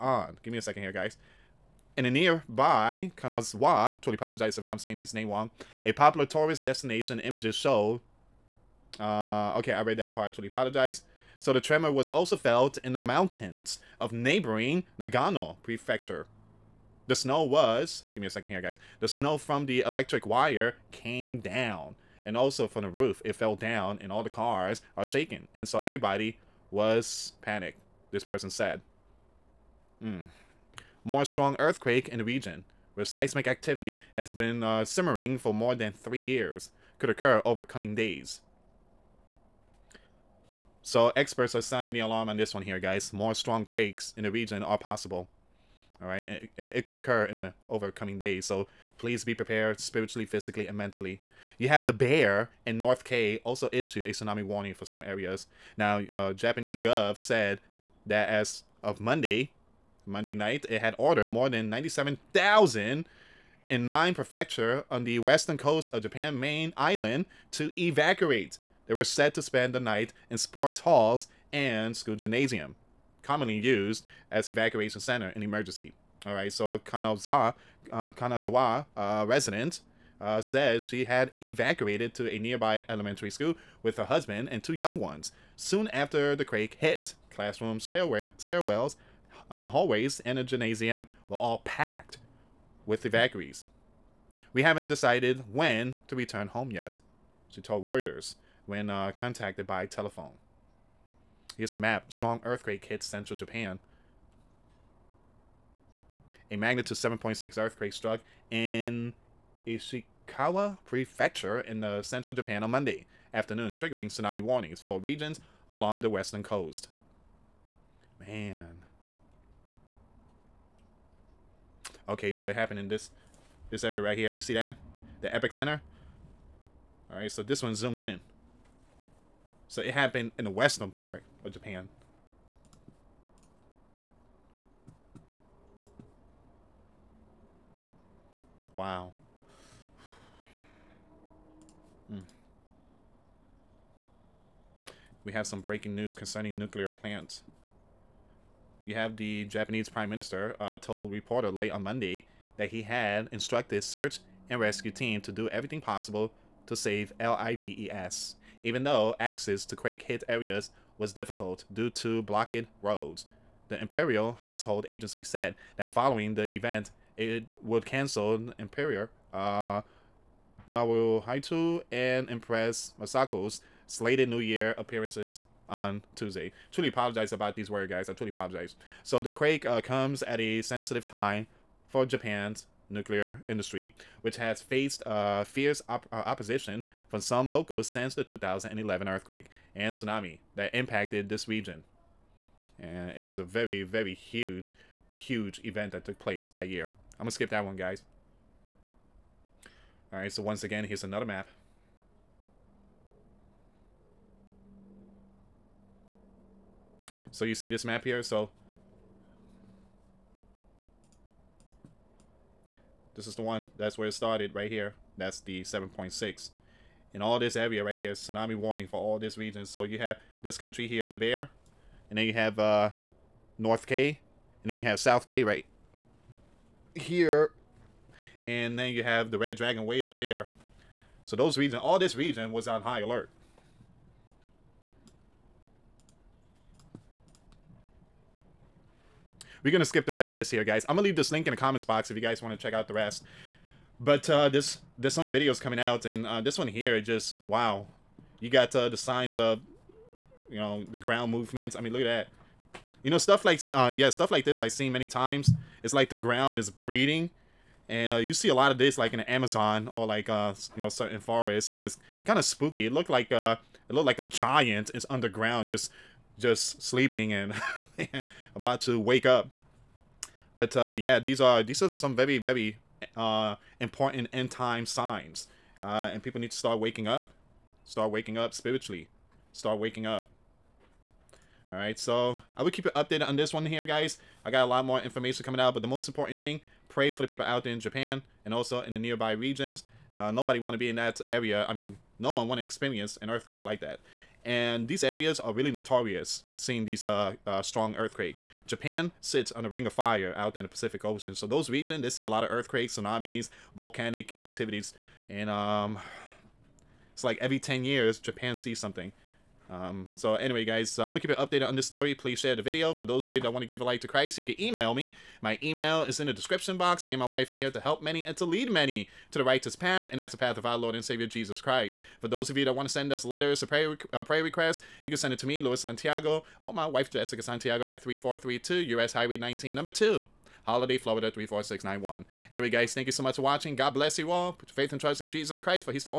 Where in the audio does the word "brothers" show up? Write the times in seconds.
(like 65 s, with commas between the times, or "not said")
not said.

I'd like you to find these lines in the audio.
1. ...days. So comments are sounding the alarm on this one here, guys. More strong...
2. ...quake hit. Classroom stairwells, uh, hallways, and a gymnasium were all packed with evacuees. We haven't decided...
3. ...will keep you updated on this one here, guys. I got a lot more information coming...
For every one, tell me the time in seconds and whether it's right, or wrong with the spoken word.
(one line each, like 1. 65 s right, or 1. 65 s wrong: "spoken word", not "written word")
1. 37 s wrong: "experts", not "comments"
2. 86 s right
3. 282 s right.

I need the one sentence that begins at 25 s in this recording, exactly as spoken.
And so everybody was panicked, this person said.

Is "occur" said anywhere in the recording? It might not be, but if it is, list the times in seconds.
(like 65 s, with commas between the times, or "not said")
37 s, 46 s.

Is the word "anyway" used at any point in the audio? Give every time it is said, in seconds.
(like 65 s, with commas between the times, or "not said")
310 s, 332 s.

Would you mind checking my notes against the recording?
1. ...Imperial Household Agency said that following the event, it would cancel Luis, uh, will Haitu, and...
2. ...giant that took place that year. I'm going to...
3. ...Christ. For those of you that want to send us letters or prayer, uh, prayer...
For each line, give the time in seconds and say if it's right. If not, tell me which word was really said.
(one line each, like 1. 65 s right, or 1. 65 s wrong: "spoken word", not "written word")
1. 163 s wrong: "Imperior", not "Luis"
2. 195 s wrong: "event", not "giant"
3. 321 s right.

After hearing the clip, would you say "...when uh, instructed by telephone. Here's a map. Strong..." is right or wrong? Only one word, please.
wrong.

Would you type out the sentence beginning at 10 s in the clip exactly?
Totally apologize so the tremor was also felt in the mountains of neighboring Nagano Prefecture.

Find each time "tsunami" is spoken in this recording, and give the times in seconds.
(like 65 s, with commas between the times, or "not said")
54 s, 114 s, 189 s, 218 s, 302 s.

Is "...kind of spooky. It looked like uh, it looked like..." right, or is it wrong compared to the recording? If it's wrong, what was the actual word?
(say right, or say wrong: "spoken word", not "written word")
right.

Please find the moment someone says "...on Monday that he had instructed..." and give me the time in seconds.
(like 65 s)
151 s.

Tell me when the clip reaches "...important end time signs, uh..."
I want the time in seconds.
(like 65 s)
273 s.